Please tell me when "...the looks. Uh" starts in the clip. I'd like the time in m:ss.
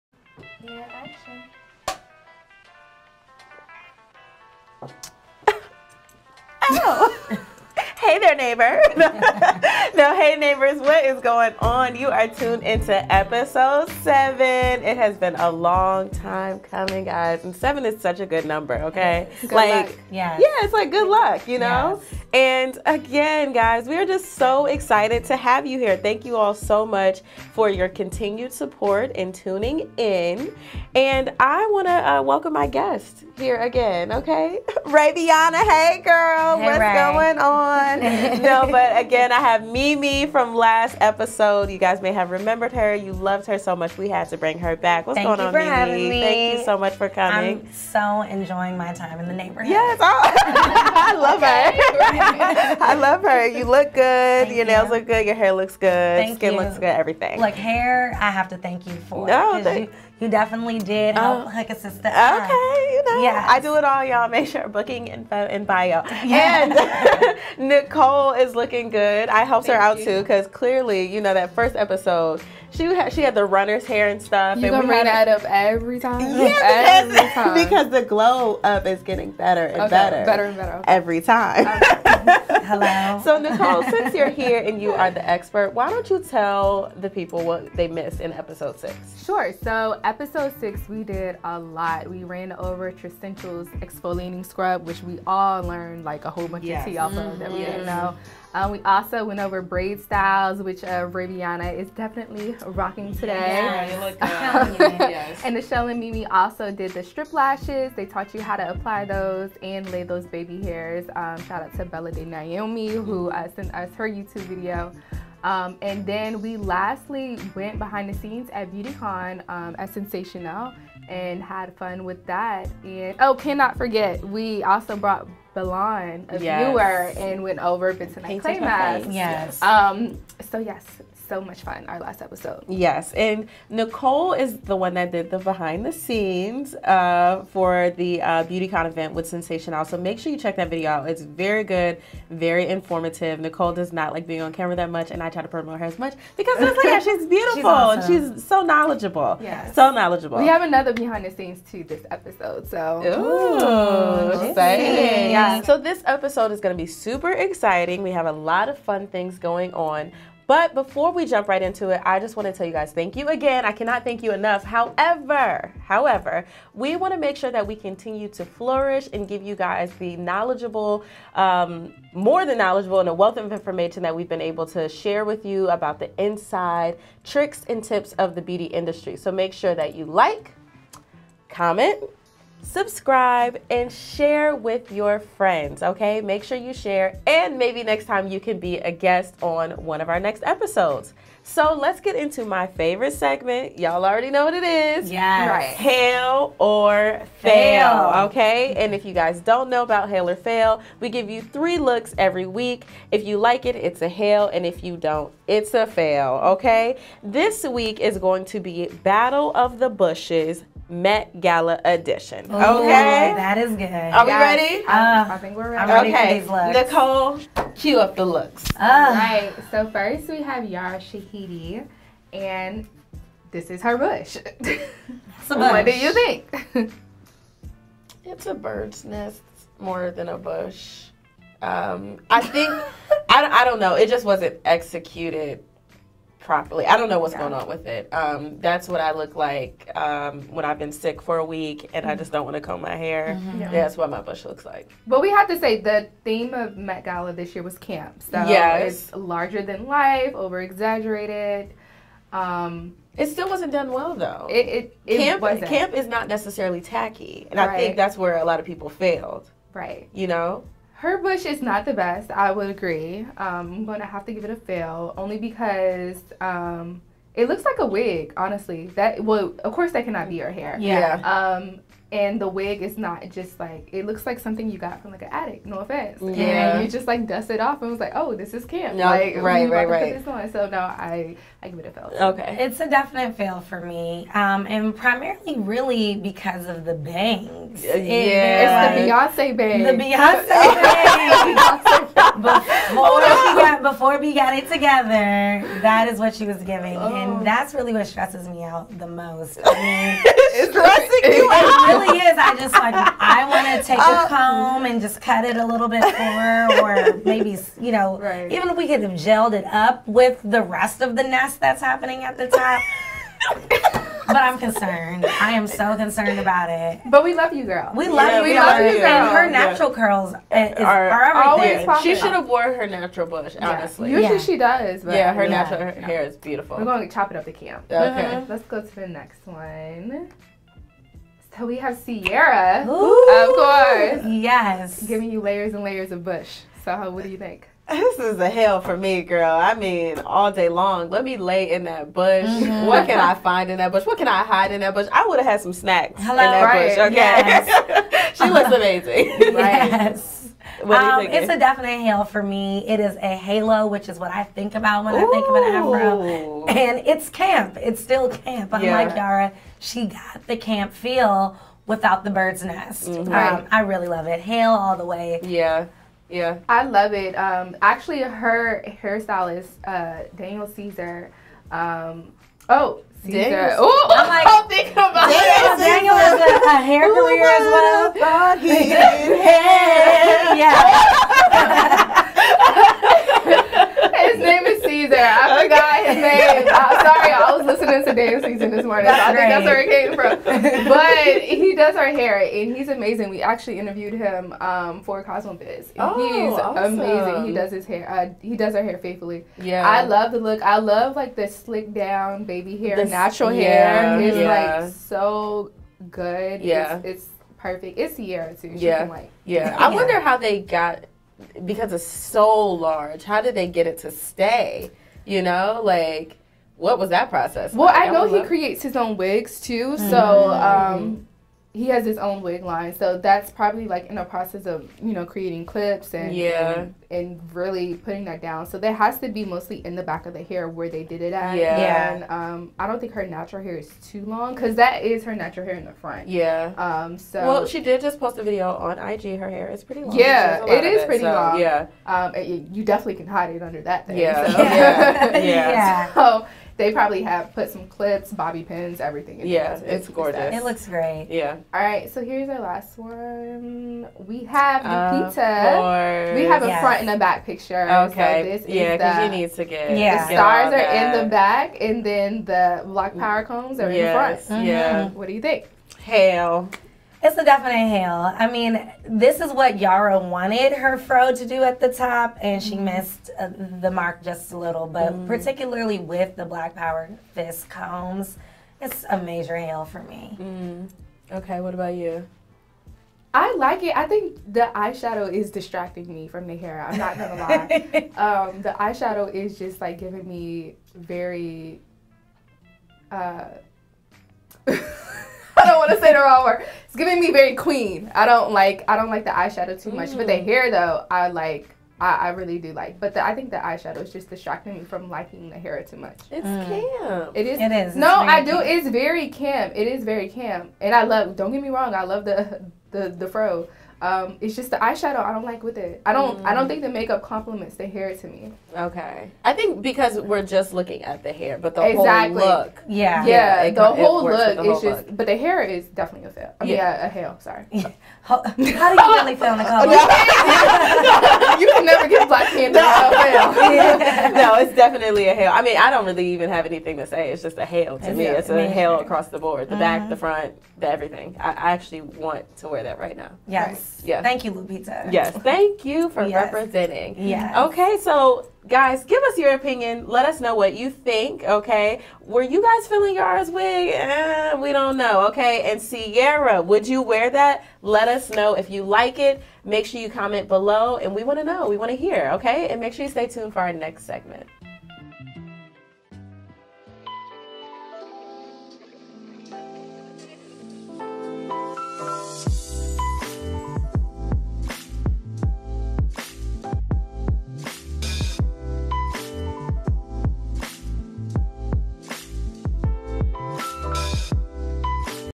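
3:38.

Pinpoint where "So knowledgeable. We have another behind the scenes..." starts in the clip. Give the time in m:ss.
2:29.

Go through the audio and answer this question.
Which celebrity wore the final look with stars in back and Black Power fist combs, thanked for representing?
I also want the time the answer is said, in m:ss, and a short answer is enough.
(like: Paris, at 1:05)
Lupita, at 9:04.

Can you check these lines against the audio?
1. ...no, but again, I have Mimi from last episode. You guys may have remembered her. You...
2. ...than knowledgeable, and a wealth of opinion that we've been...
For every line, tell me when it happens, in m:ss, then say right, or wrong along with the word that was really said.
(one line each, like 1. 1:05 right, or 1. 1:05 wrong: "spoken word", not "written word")
1. 0:38 right
2. 2:52 wrong: "information", not "opinion".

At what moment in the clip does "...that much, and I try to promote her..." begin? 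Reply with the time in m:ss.
2:24.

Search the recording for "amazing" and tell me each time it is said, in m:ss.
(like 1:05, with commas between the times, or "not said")
5:48, 6:32, 6:36.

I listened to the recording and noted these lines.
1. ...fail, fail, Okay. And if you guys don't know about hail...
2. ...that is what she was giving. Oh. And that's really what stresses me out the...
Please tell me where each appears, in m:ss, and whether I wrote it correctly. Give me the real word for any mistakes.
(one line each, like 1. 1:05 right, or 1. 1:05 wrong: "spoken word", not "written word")
1. 3:17 right
2. 4:55 right.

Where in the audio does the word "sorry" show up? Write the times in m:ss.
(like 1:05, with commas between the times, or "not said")
6:27, 8:47.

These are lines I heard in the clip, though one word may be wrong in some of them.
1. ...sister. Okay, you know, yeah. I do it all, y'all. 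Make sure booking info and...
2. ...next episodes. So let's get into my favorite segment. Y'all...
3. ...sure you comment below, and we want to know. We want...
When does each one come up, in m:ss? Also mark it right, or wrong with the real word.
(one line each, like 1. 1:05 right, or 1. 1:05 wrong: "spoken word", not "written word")
1. 1:01 right
2. 3:10 right
3. 9:19 right.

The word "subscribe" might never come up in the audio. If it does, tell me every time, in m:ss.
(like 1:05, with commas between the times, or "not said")
3:02.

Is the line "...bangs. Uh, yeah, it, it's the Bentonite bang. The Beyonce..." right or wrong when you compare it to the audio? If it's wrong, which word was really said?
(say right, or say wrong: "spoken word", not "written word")
wrong: "Beyonce", not "Bentonite".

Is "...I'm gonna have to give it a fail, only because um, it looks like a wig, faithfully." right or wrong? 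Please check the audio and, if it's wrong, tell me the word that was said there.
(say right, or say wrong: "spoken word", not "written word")
wrong: "honestly", not "faithfully".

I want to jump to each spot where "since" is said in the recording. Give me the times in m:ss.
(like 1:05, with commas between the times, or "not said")
1:23.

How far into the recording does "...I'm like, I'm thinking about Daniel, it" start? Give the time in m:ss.
6:14.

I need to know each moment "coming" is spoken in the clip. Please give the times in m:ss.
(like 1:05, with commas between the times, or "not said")
0:16, 0:47.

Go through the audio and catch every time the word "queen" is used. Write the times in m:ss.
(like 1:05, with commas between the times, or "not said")
8:17.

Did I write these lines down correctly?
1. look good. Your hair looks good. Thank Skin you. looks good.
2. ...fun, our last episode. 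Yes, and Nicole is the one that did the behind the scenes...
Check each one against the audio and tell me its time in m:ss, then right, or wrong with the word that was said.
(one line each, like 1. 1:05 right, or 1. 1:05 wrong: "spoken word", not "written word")
1. 0:54 right
2. 2:11 right.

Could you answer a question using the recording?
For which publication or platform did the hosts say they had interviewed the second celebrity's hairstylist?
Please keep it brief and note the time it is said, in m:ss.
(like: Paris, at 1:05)
CosmoBiz, at 6:35.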